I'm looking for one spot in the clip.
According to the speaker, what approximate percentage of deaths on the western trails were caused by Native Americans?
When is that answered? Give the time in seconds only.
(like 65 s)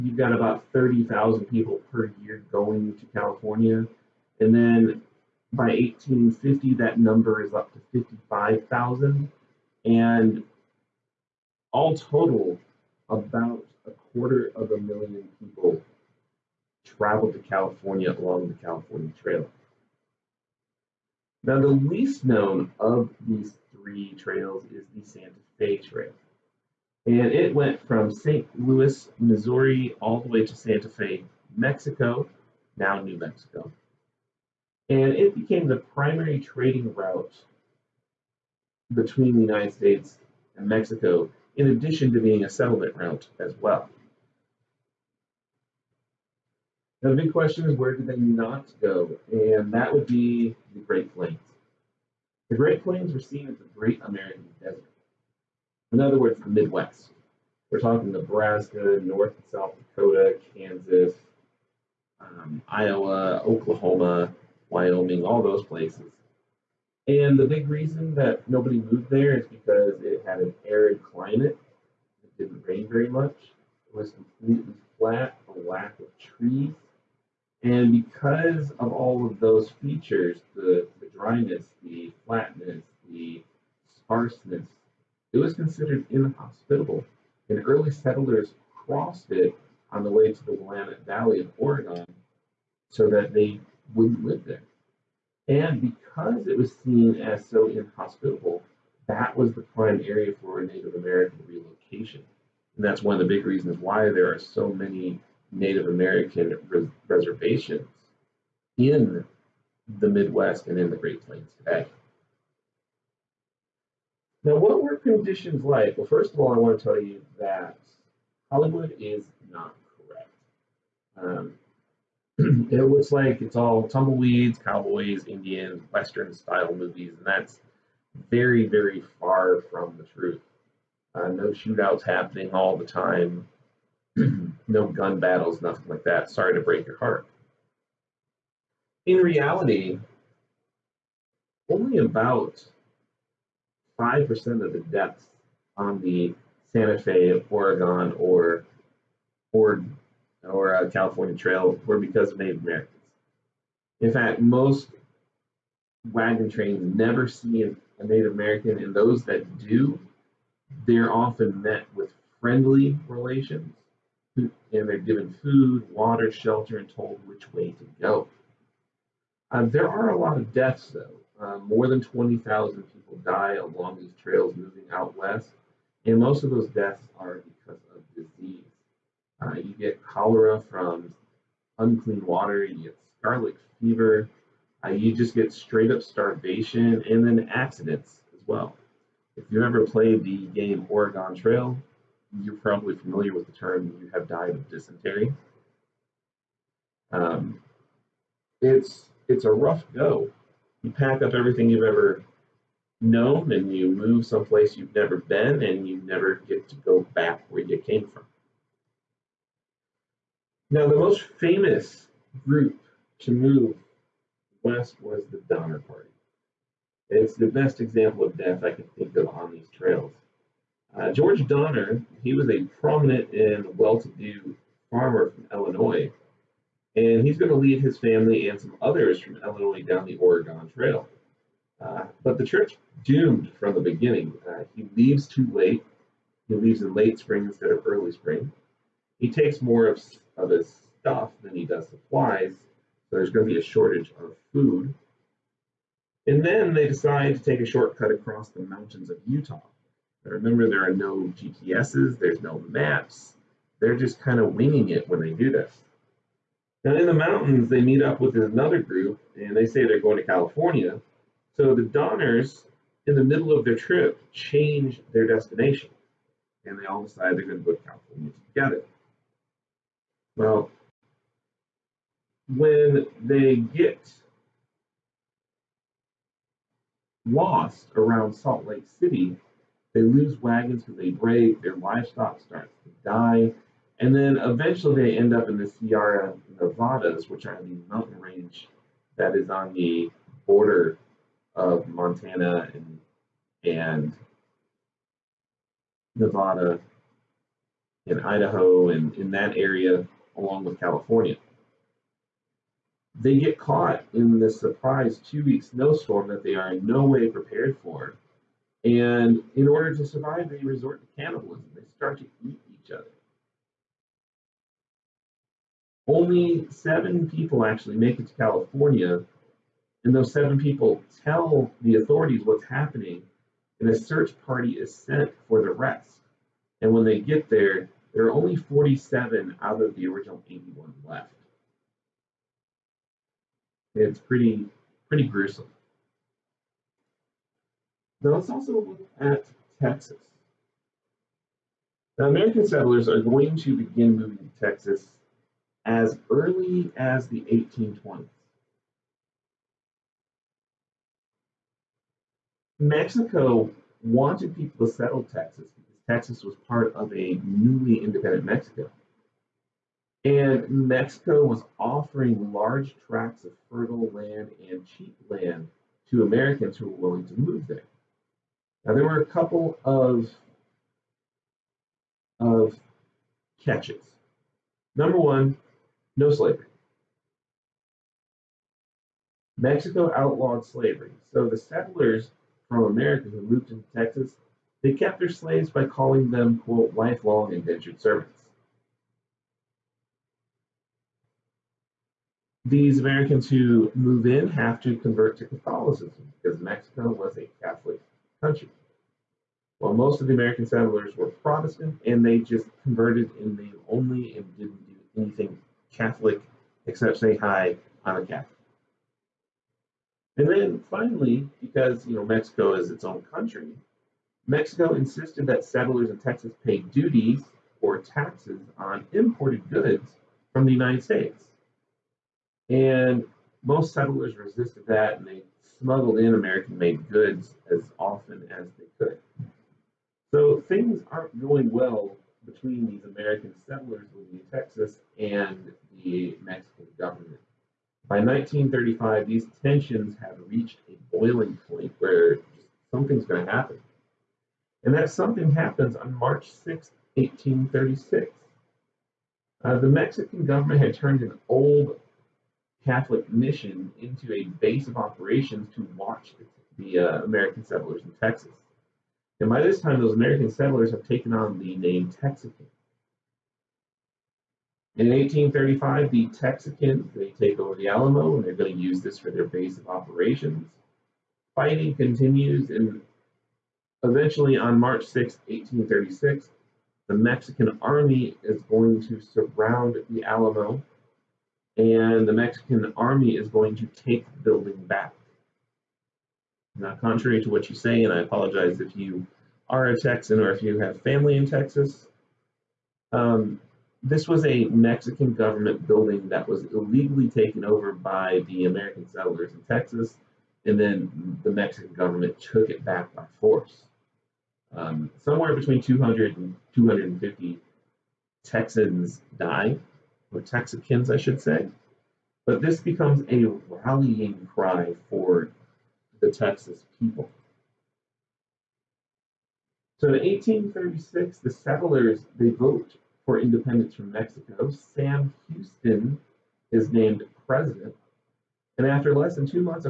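144 s.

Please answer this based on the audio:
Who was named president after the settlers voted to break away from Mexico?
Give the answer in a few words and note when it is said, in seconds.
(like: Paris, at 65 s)
Sam Houston, at 524 s.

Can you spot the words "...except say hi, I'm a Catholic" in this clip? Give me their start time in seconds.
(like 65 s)
406 s.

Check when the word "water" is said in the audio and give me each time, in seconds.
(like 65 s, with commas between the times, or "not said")
165 s, 182 s.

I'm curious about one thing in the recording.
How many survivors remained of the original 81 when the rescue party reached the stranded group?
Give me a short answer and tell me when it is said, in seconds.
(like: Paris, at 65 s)
47, at 328 s.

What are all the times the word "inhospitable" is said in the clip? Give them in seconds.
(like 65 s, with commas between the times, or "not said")
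86 s, 97 s.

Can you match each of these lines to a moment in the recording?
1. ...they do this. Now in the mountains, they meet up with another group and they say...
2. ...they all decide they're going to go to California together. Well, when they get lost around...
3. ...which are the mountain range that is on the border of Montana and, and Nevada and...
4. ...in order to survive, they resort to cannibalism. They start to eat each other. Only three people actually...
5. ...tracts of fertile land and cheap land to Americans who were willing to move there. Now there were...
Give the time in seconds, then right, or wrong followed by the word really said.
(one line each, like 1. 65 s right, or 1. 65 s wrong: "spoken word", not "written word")
1. 255 s right
2. 266 s right
3. 287 s right
4. 309 s wrong: "seven", not "three"
5. 363 s right.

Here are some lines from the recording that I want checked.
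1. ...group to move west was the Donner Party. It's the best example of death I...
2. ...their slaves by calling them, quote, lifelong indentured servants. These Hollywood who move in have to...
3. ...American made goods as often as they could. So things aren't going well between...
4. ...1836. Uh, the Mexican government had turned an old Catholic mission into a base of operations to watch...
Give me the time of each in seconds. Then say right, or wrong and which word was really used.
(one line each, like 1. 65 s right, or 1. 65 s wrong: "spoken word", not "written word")
1. 212 s right
2. 385 s wrong: "Americans", not "Hollywood"
3. 426 s right
4. 447 s right.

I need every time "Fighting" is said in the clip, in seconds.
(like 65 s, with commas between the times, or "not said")
471 s.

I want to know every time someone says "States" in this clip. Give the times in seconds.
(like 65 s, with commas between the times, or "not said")
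39 s, 421 s.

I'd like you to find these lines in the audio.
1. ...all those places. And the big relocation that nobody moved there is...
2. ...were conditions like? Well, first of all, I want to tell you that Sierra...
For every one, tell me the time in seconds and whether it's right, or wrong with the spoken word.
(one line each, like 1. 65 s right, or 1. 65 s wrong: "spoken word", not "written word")
1. 65 s wrong: "reason", not "relocation"
2. 114 s wrong: "Hollywood", not "Sierra".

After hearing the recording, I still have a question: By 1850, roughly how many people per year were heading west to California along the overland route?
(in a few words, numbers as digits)
55,000.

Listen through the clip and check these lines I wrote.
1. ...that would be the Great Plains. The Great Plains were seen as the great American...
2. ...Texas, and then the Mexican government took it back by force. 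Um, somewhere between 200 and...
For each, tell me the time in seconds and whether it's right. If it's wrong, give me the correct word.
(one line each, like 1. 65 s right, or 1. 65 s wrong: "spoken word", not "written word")
1. 49 s right
2. 499 s right.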